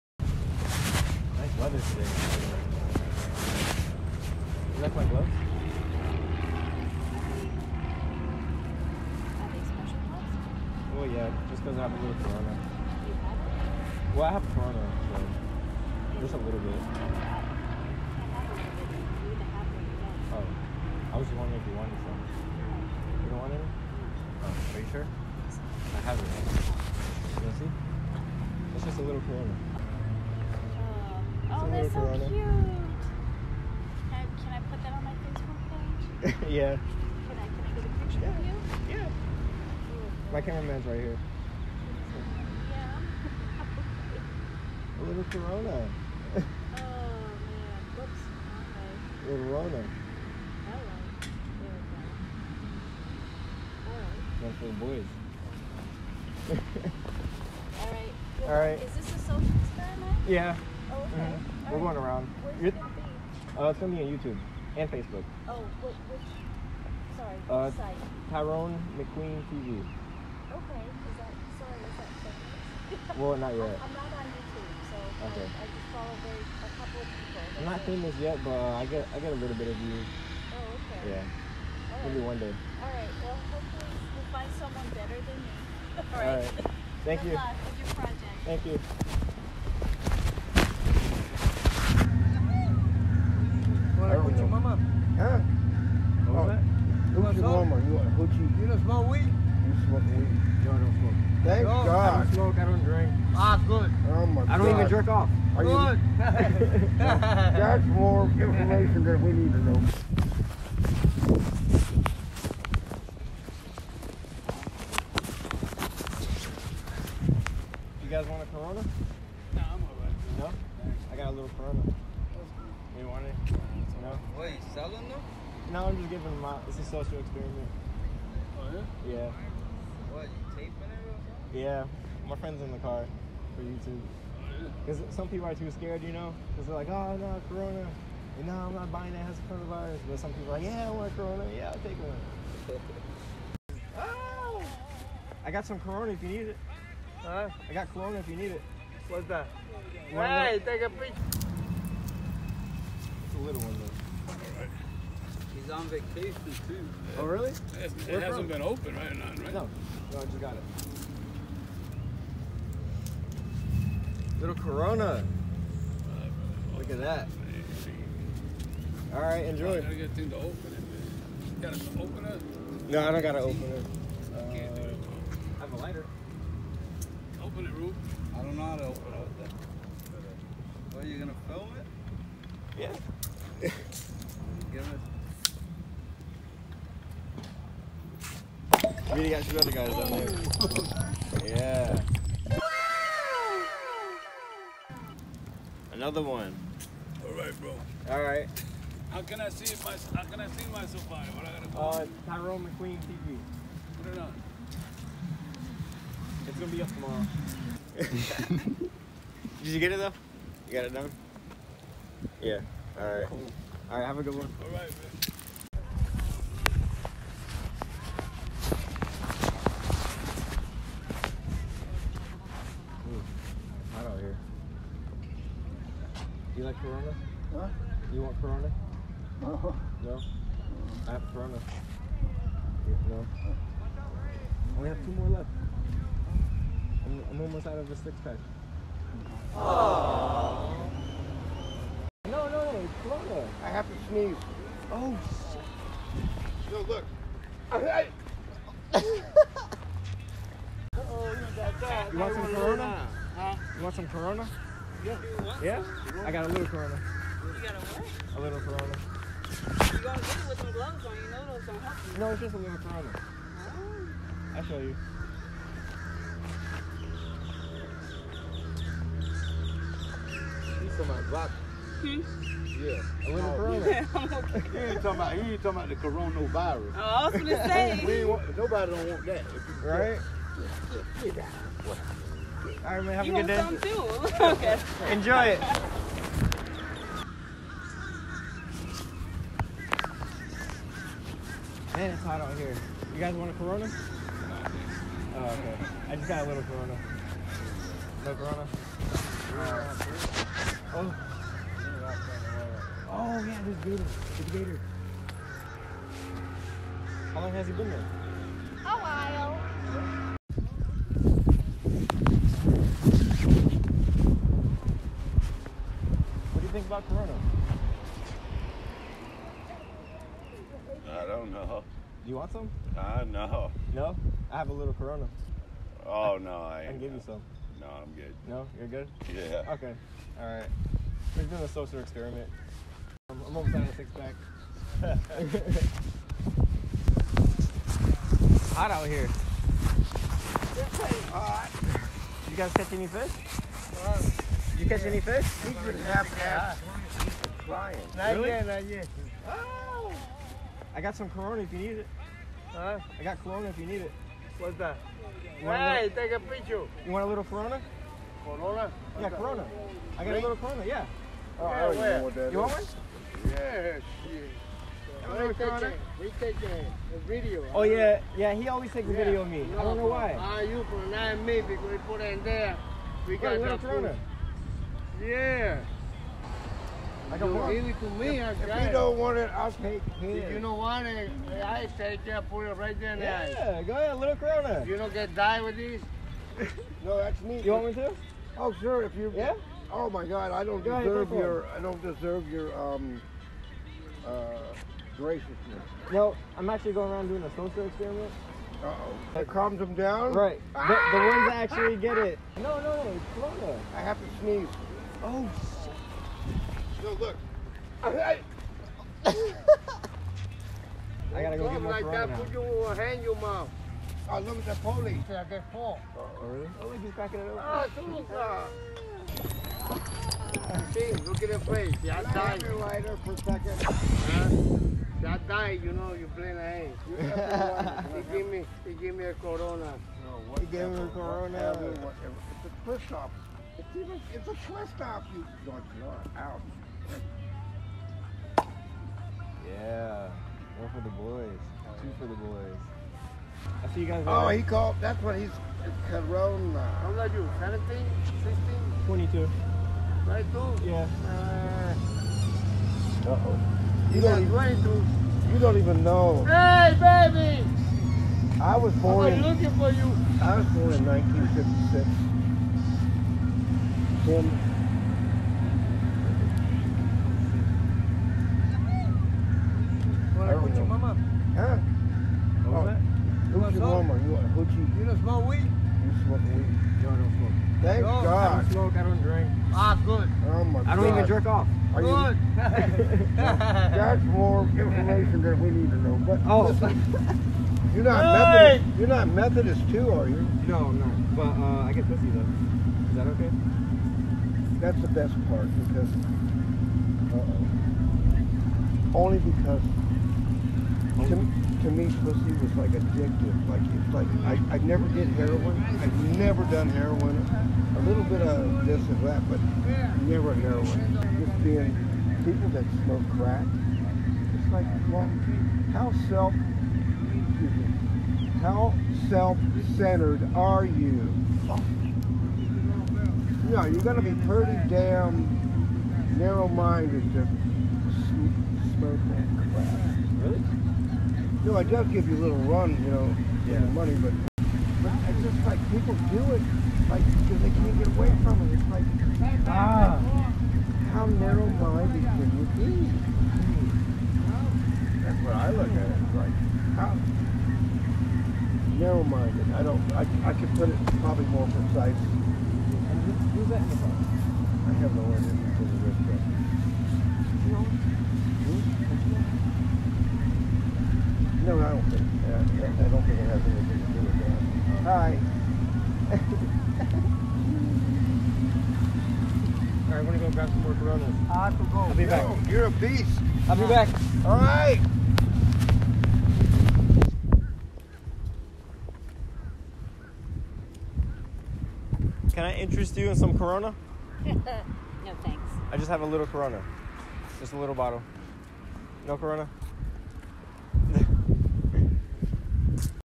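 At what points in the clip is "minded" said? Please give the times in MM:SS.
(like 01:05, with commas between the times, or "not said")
08:46, 09:01, 09:08.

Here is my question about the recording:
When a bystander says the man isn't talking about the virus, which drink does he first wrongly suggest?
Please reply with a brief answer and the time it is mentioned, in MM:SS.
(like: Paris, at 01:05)
vodka, at 04:31.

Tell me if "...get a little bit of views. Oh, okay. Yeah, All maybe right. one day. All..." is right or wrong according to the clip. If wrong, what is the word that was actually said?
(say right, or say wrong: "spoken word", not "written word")
right.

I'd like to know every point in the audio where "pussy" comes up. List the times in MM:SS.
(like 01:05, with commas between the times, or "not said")
08:12, 08:22.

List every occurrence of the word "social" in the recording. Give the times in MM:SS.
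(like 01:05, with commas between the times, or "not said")
00:59, 02:06, 05:31, 06:37.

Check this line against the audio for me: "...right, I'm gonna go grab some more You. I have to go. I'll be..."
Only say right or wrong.
wrong.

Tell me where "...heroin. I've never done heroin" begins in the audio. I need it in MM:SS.
08:25.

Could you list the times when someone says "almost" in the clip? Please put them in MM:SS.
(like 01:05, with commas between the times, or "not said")
03:57, 05:33.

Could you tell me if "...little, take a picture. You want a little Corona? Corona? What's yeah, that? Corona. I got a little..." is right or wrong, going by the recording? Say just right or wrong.
right.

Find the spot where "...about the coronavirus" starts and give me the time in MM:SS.
04:35.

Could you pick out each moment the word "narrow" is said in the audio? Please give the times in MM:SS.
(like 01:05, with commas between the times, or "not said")
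08:46, 09:01, 09:08.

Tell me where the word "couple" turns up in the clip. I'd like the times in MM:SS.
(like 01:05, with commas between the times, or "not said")
01:16.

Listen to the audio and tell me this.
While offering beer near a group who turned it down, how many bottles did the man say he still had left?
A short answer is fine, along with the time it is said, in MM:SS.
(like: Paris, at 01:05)
2, at 03:55.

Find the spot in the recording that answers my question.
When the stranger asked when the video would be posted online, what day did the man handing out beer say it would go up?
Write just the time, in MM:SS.
03:26.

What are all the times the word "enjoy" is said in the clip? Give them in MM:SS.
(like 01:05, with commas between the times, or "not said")
02:49, 04:45.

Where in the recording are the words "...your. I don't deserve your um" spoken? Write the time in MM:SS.
06:31.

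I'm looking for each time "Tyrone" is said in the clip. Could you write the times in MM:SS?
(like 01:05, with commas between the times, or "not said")
01:08, 03:22.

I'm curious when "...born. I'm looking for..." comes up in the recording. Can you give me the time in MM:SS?
07:38.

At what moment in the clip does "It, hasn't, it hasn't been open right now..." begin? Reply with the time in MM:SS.
02:37.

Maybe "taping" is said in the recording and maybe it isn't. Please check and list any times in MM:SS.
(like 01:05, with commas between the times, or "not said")
02:10.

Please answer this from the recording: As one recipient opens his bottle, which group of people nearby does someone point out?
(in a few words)
the police.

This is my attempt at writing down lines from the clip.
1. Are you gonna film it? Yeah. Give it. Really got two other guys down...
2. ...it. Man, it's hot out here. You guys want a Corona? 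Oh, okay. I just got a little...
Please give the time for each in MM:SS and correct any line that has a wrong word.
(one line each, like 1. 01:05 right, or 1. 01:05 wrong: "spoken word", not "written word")
1. 03:01 right
2. 04:45 right.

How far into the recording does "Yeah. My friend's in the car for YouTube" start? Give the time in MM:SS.
02:11.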